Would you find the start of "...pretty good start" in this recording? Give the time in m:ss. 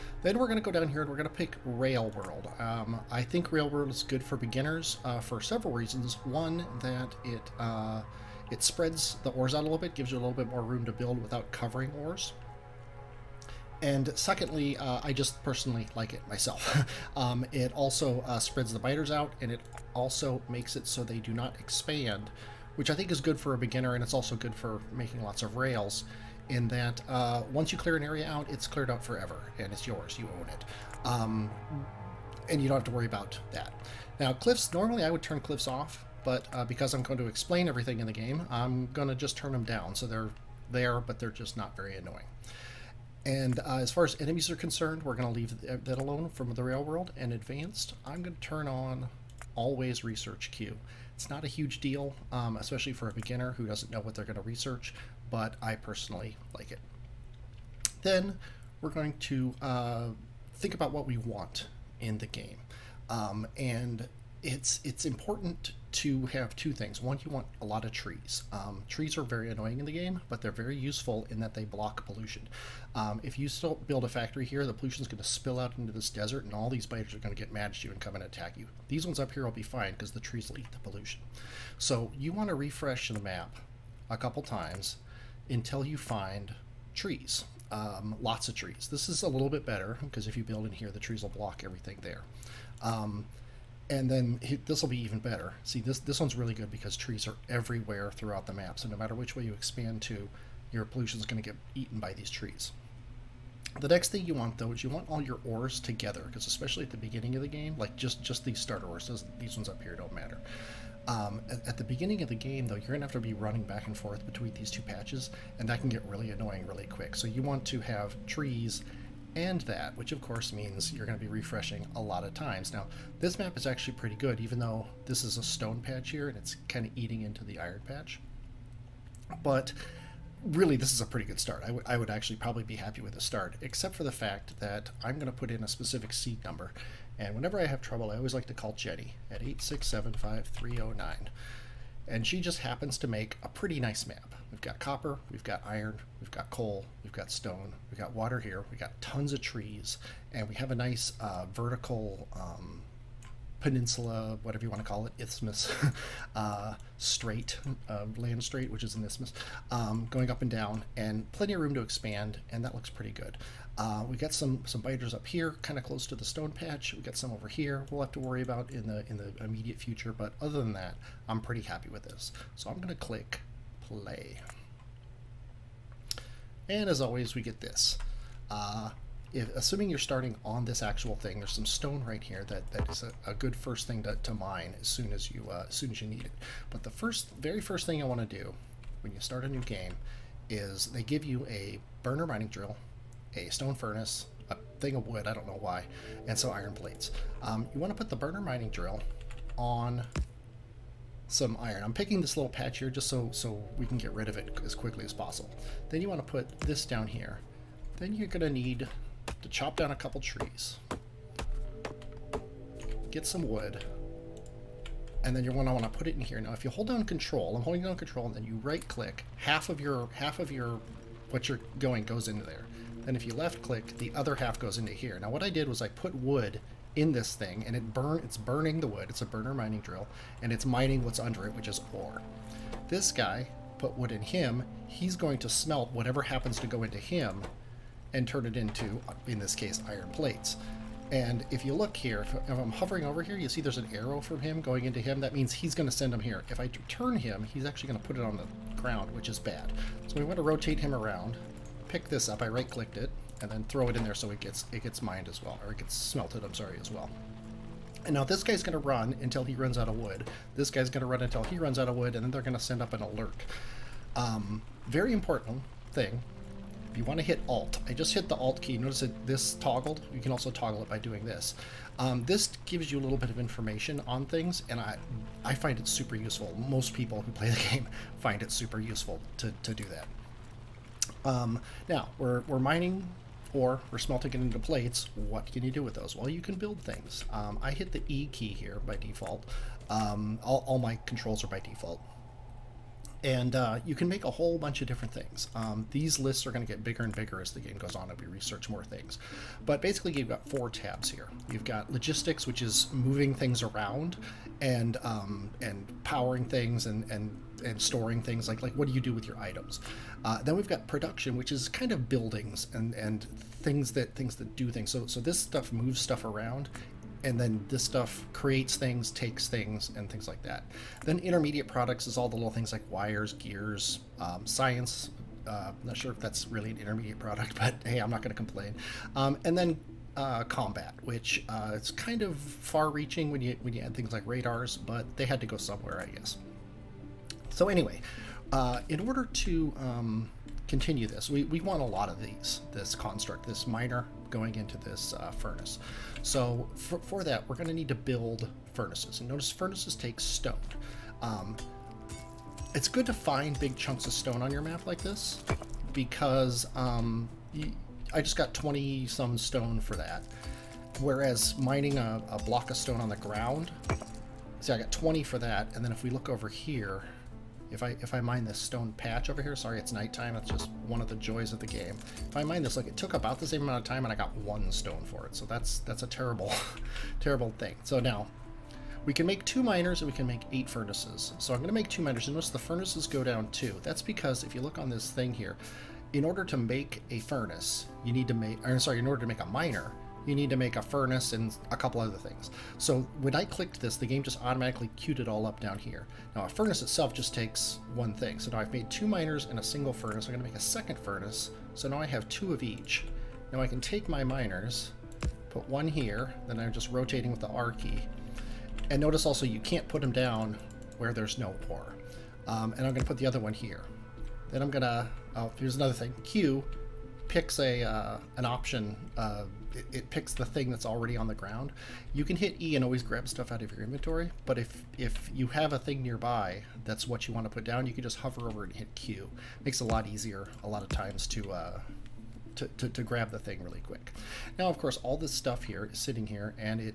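2:11.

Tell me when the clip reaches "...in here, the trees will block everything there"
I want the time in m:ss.
1:30.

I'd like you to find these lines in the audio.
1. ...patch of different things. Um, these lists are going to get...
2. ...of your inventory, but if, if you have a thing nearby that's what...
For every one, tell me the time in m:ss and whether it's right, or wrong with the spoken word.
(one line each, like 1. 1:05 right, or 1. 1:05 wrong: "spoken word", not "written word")
1. 4:54 wrong: "bunch", not "patch"
2. 7:03 right.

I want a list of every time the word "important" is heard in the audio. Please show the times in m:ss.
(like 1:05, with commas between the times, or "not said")
1:05, 4:25.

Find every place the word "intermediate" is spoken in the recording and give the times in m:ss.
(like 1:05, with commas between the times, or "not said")
5:21, 5:26.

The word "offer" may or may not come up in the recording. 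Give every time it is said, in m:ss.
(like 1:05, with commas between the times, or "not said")
not said.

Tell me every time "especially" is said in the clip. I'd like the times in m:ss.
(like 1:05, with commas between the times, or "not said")
0:52, 1:46.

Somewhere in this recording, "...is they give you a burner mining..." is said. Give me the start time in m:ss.
3:10.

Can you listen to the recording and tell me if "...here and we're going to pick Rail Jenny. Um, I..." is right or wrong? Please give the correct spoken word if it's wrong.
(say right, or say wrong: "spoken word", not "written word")
wrong: "World", not "Jenny".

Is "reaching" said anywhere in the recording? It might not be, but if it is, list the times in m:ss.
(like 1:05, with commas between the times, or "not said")
5:32.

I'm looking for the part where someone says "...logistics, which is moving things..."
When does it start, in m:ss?
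5:01.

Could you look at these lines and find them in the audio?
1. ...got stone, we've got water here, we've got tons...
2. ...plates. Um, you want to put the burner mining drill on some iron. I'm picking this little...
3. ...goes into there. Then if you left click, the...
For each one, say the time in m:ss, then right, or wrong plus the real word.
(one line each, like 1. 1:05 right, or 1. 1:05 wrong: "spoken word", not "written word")
1. 2:27 right
2. 3:16 right
3. 3:42 right.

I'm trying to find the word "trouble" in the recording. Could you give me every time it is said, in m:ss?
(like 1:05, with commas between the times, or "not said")
2:17.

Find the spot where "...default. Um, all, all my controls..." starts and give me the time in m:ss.
4:48.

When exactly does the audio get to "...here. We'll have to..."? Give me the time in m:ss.
2:47.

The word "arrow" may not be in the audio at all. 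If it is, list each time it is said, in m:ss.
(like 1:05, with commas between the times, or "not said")
4:03.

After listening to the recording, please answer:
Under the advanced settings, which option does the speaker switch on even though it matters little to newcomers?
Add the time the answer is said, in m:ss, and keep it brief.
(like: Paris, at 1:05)
always research queue, at 0:49.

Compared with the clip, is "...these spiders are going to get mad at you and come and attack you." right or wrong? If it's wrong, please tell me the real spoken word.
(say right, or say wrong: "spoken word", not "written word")
right.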